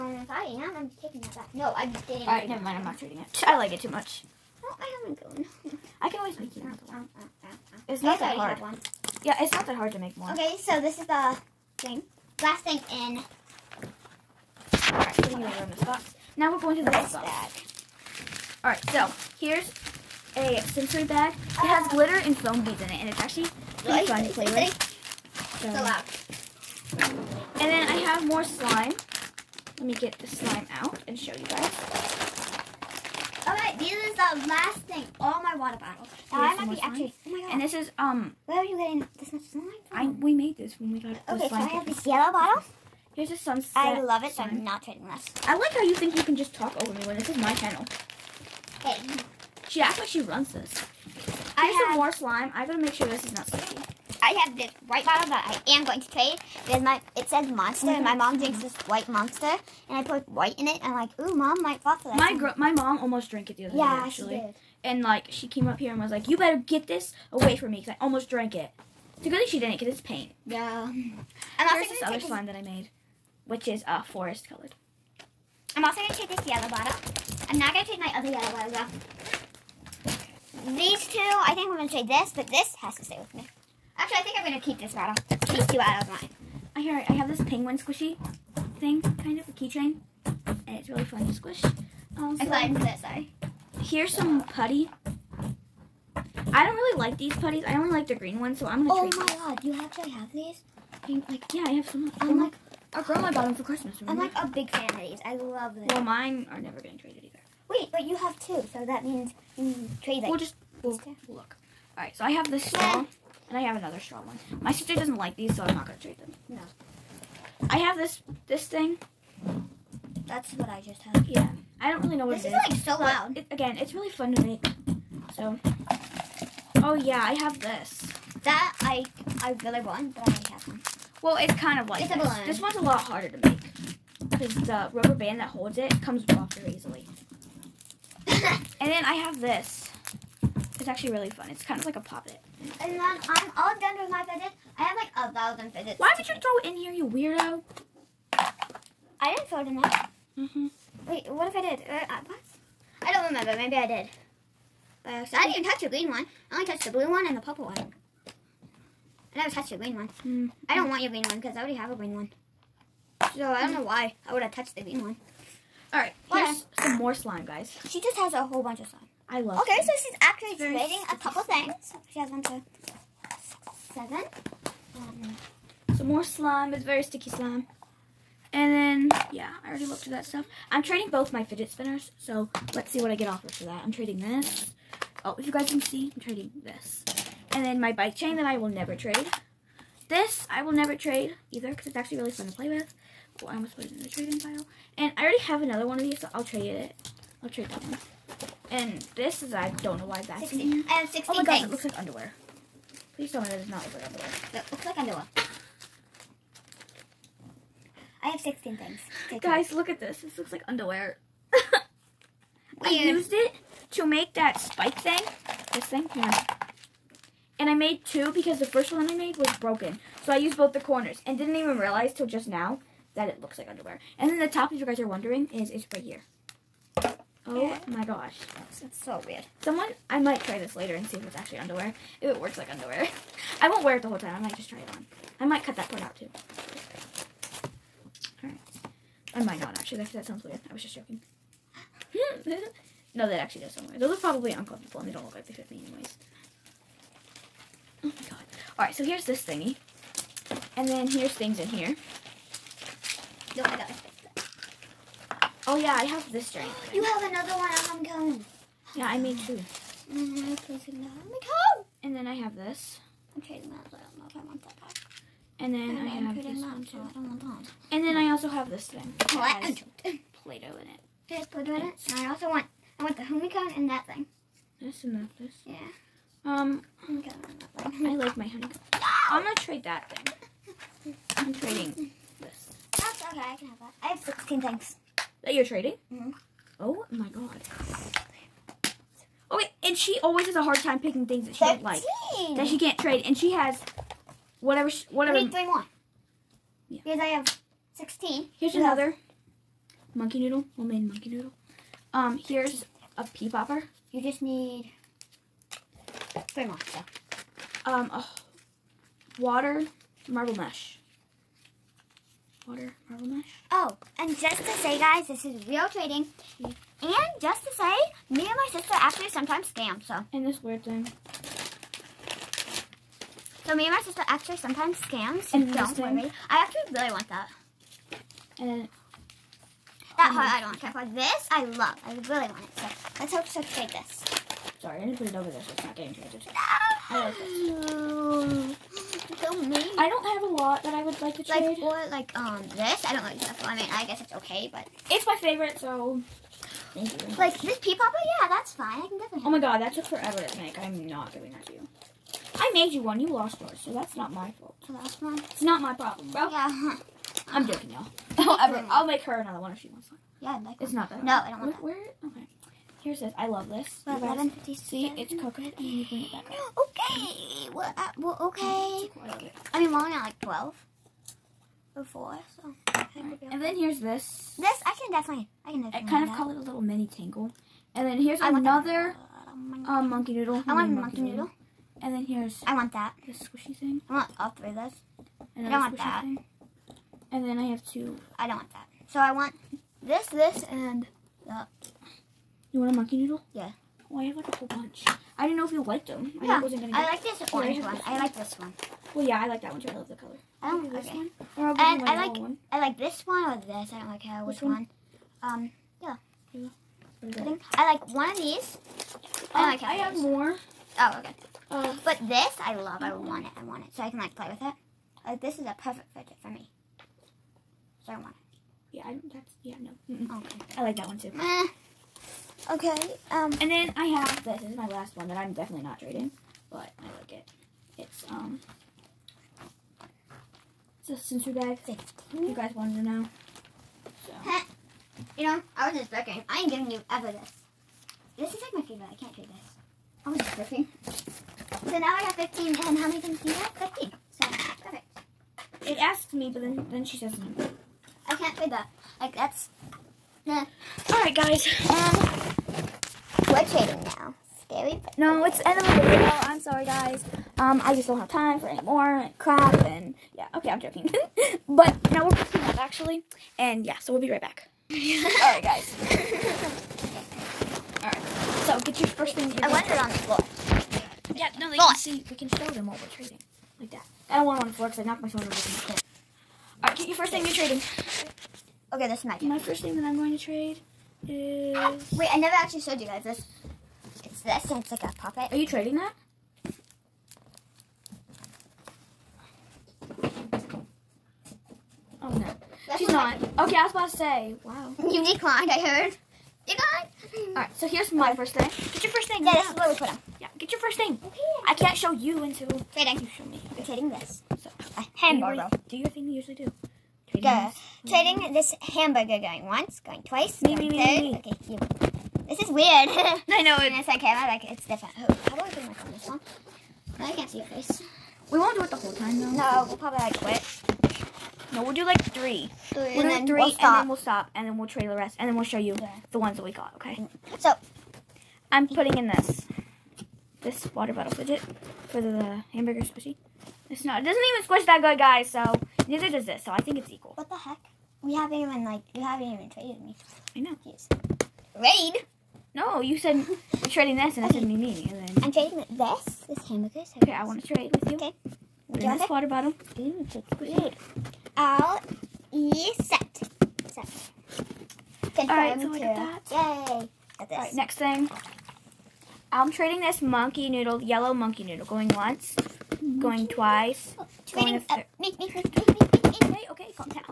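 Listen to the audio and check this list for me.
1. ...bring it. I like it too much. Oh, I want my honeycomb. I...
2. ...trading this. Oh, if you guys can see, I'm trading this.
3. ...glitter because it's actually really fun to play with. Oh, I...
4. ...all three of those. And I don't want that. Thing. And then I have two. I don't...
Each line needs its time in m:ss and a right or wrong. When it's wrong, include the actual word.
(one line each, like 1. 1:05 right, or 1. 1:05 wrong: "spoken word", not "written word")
1. 0:02 wrong: "trading", not "bring"
2. 3:03 right
3. 3:11 wrong: "either", not "glitter"
4. 6:24 right.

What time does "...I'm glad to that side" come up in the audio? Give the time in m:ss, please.
1:32.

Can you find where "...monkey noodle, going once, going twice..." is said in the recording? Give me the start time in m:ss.
9:21.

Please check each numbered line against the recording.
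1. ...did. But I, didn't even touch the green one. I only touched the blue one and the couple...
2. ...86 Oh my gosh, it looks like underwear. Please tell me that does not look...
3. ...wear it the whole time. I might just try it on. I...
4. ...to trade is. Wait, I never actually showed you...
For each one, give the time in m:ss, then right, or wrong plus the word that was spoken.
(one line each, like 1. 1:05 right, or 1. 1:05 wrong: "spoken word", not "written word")
1. 2:33 wrong: "purple", not "couple"
2. 3:21 wrong: "16", not "86"
3. 3:53 right
4. 8:00 right.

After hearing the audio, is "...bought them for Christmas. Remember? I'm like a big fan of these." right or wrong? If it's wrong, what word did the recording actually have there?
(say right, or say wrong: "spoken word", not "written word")
right.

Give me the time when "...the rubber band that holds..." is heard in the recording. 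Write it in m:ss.
2:14.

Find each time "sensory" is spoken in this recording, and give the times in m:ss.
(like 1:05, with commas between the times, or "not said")
0:20, 7:11.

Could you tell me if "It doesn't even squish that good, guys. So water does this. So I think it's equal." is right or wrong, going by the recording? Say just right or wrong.
wrong.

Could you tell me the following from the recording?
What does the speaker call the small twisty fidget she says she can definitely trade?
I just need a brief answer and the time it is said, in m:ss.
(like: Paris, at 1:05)
mini tangle, at 6:16.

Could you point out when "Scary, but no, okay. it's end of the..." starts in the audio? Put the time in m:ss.
7:34.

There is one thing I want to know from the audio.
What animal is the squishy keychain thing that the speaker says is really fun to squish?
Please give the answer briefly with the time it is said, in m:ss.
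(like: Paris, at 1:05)
penguin, at 1:27.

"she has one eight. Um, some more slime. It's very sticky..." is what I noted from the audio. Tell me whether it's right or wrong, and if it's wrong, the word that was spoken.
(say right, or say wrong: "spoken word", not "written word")
wrong: "seven", not "eight".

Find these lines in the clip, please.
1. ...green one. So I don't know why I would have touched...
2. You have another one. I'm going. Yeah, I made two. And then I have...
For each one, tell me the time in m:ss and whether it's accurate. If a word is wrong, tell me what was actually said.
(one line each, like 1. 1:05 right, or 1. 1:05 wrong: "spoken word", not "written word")
1. 2:41 right
2. 4:16 right.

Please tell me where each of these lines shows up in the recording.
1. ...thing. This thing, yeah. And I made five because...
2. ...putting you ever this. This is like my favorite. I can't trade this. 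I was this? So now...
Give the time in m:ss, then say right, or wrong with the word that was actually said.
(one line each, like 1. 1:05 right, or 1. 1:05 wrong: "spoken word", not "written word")
1. 3:34 wrong: "two", not "five"
2. 7:16 wrong: "giving", not "putting".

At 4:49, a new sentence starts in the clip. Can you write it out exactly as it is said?
Oh wait, and she always has a hard time picking things that she does don't like.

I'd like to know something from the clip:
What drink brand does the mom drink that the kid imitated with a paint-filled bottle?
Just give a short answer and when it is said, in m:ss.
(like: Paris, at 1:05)
white monster, at 0:58.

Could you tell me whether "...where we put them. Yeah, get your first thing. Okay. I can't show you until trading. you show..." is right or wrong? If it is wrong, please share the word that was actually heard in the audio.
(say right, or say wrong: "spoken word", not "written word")
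right.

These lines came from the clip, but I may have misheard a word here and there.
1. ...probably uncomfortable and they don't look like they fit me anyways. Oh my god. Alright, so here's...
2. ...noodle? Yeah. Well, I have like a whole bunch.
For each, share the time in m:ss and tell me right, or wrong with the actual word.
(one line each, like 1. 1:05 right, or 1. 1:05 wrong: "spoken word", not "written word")
1. 4:04 right
2. 6:33 right.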